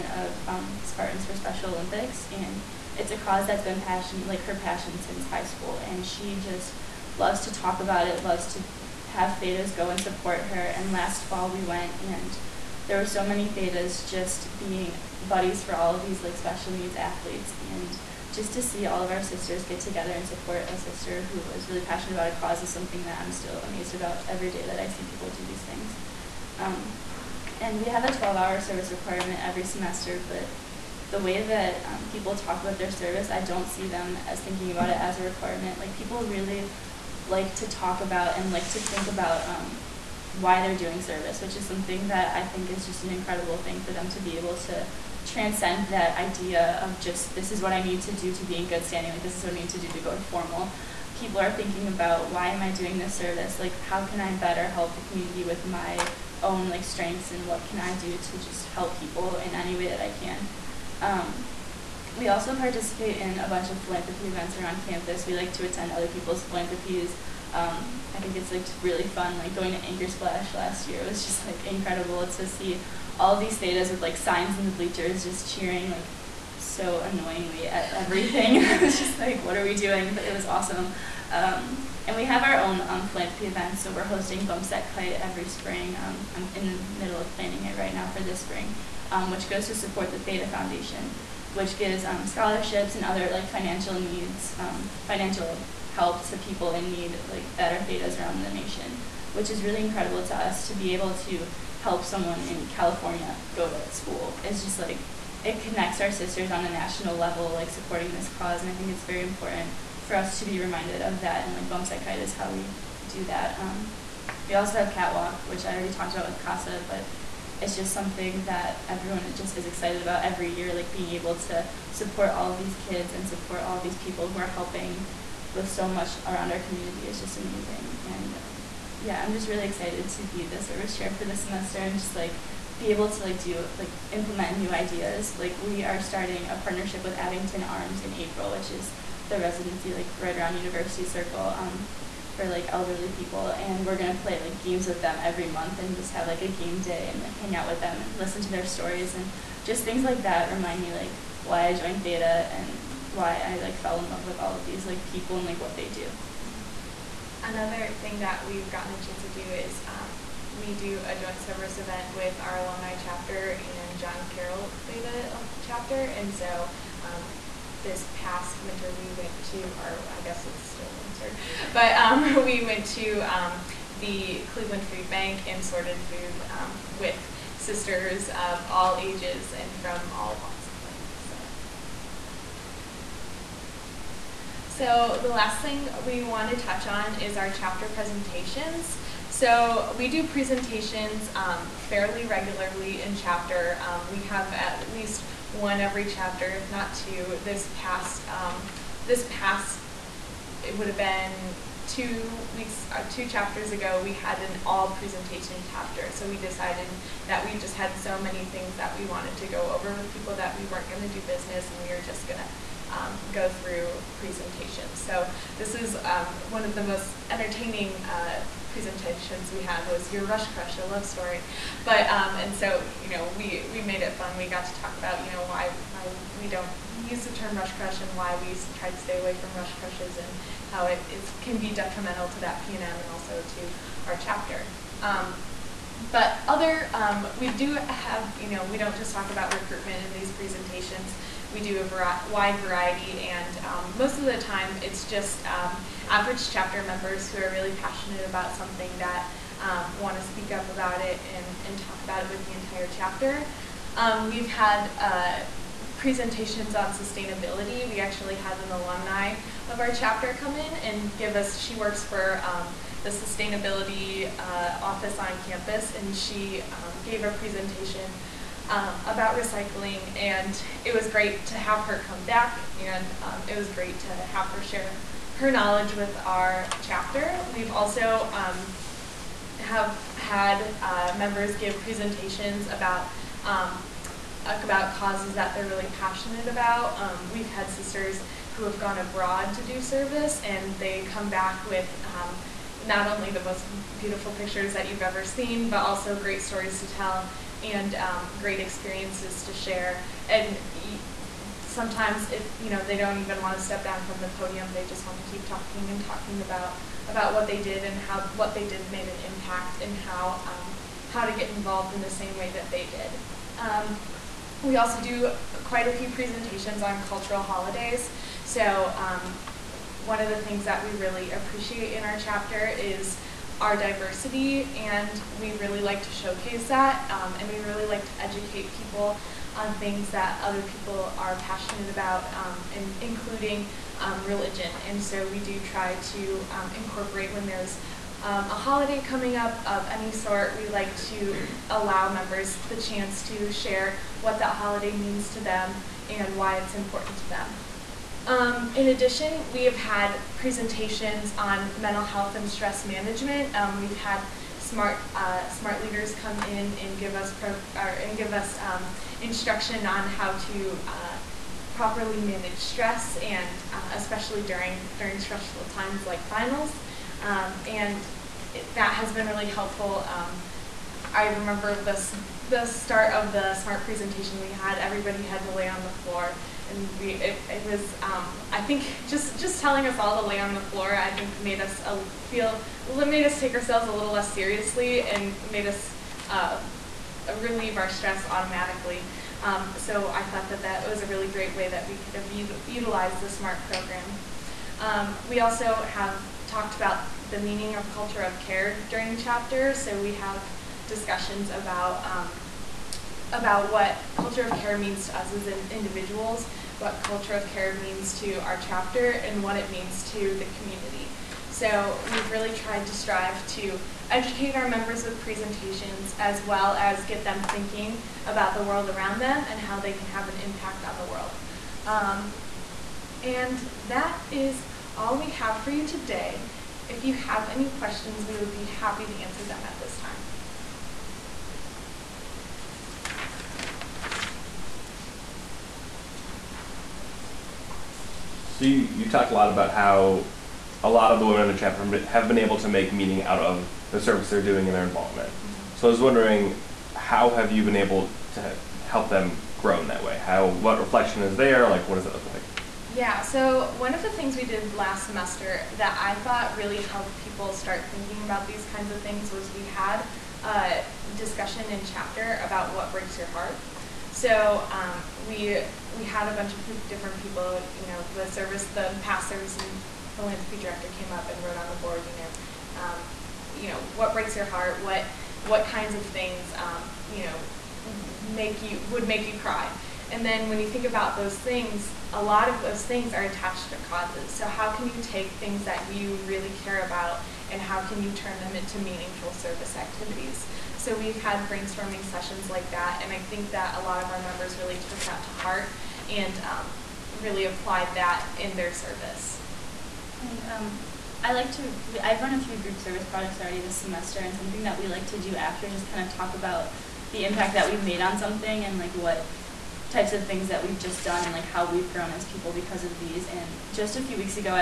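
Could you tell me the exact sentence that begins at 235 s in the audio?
Um, but other, um, we do have, you know, we don't just talk about recruitment in these presentations.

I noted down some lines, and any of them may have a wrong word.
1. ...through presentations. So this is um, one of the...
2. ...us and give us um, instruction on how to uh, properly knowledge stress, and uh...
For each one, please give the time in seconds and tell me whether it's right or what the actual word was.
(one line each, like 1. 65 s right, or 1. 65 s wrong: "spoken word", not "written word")
1. 213 s right
2. 357 s wrong: "manage", not "knowledge".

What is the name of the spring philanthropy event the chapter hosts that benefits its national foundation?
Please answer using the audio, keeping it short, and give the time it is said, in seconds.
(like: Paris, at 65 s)
Bump Set Kite, at 84 s.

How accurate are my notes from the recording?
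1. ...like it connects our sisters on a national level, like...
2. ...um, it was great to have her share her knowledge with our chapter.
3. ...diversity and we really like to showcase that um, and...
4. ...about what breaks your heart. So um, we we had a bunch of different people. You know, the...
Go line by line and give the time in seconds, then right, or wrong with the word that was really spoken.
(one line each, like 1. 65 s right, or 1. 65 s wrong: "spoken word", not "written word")
1. 104 s right
2. 273 s right
3. 323 s right
4. 462 s right.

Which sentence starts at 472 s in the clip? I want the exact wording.
You know, um, you know what breaks your heart.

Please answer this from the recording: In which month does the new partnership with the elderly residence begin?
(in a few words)
April.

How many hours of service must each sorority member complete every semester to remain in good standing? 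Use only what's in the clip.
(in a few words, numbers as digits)
12.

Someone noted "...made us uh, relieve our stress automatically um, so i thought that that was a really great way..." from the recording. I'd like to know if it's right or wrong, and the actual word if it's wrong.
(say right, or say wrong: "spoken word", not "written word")
right.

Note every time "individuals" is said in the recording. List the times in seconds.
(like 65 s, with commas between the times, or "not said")
405 s.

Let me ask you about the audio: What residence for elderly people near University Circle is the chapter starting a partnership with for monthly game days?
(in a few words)
Abington Arms.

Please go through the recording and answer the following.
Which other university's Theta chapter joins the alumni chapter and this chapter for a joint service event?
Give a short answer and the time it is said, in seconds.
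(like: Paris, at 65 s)
John Carroll, at 163 s.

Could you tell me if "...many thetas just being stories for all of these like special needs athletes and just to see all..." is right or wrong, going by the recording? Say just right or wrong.
wrong.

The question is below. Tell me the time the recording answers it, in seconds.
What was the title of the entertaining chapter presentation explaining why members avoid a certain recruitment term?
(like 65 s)
220 s.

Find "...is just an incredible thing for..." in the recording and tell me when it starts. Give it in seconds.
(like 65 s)
42 s.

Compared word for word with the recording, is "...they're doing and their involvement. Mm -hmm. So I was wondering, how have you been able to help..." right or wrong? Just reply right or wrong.
right.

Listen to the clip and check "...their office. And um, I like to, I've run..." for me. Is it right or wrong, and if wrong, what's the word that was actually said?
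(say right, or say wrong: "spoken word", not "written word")
wrong: "service", not "office".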